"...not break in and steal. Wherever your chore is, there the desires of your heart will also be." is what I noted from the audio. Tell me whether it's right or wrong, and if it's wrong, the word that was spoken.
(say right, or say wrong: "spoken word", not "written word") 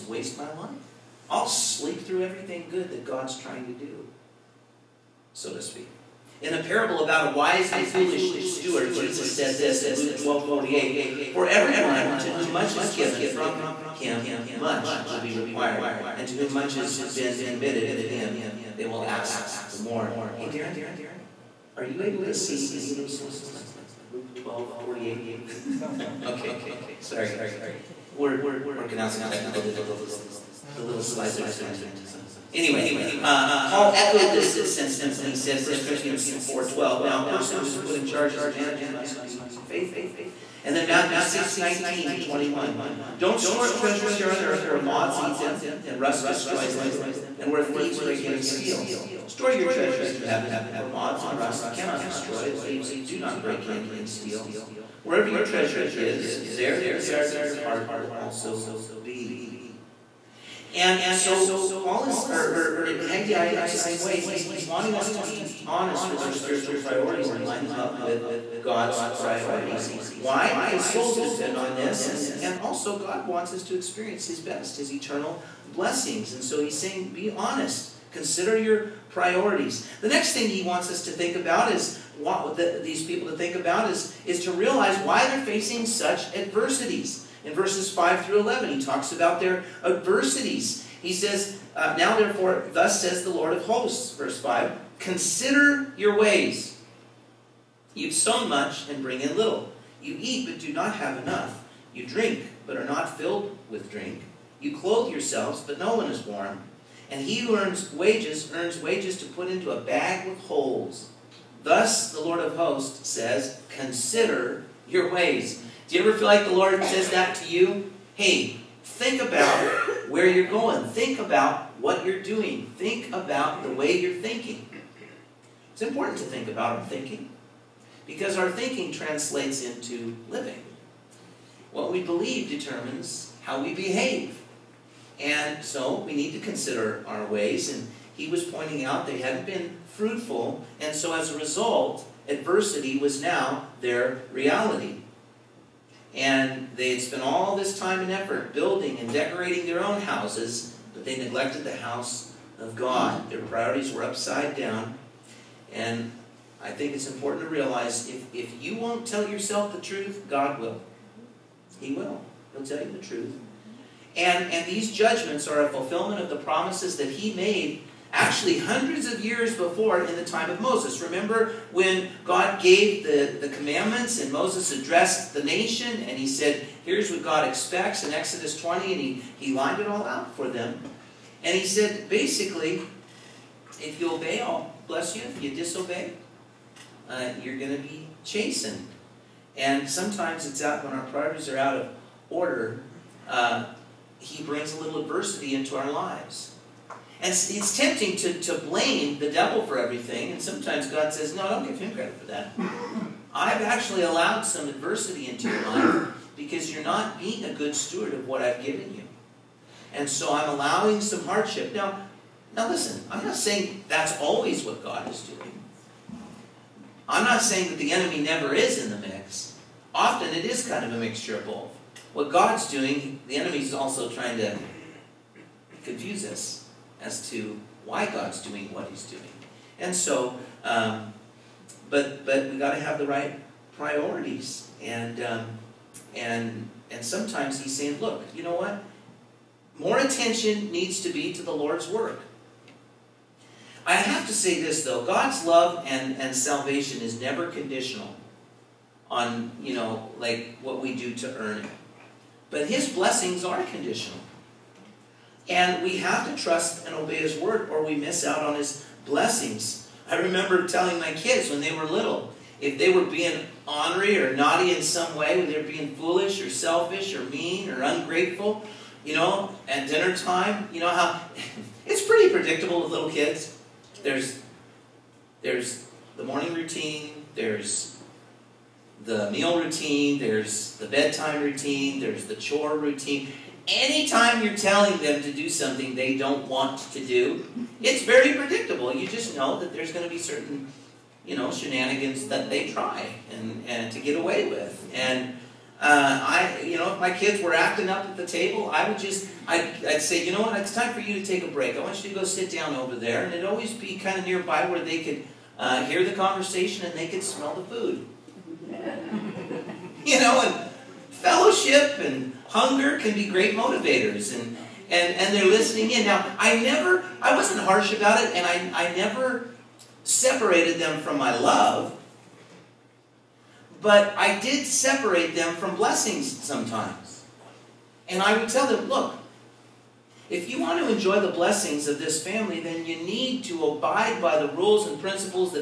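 wrong: "treasure", not "chore".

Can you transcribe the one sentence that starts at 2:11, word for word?
What we believe determines how we behave.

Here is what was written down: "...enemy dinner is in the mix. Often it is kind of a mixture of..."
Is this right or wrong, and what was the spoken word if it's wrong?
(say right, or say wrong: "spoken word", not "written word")
wrong: "never", not "dinner".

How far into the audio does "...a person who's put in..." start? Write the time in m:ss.
0:37.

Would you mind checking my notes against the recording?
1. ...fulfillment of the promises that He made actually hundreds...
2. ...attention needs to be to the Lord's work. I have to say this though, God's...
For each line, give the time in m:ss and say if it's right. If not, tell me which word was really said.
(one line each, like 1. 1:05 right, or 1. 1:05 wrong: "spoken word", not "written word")
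1. 2:45 right
2. 3:59 right.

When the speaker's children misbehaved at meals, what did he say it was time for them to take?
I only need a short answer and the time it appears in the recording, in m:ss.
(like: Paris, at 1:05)
A break, at 5:01.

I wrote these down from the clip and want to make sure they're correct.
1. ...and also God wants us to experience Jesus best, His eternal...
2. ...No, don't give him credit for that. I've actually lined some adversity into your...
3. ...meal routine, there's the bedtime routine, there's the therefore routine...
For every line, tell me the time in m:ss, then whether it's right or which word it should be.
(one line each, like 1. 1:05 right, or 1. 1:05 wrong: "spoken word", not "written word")
1. 1:12 wrong: "His", not "Jesus"
2. 3:21 wrong: "allowed", not "lined"
3. 4:39 wrong: "chore", not "therefore".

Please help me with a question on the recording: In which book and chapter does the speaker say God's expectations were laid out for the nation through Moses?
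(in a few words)
Exodus 20.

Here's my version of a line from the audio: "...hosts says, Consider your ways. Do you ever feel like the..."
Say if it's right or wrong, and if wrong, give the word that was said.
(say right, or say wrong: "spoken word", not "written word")
right.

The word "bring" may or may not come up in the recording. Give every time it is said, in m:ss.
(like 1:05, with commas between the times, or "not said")
1:39, 3:14.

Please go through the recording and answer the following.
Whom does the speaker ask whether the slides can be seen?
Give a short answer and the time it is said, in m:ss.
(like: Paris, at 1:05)
Darren, at 0:20.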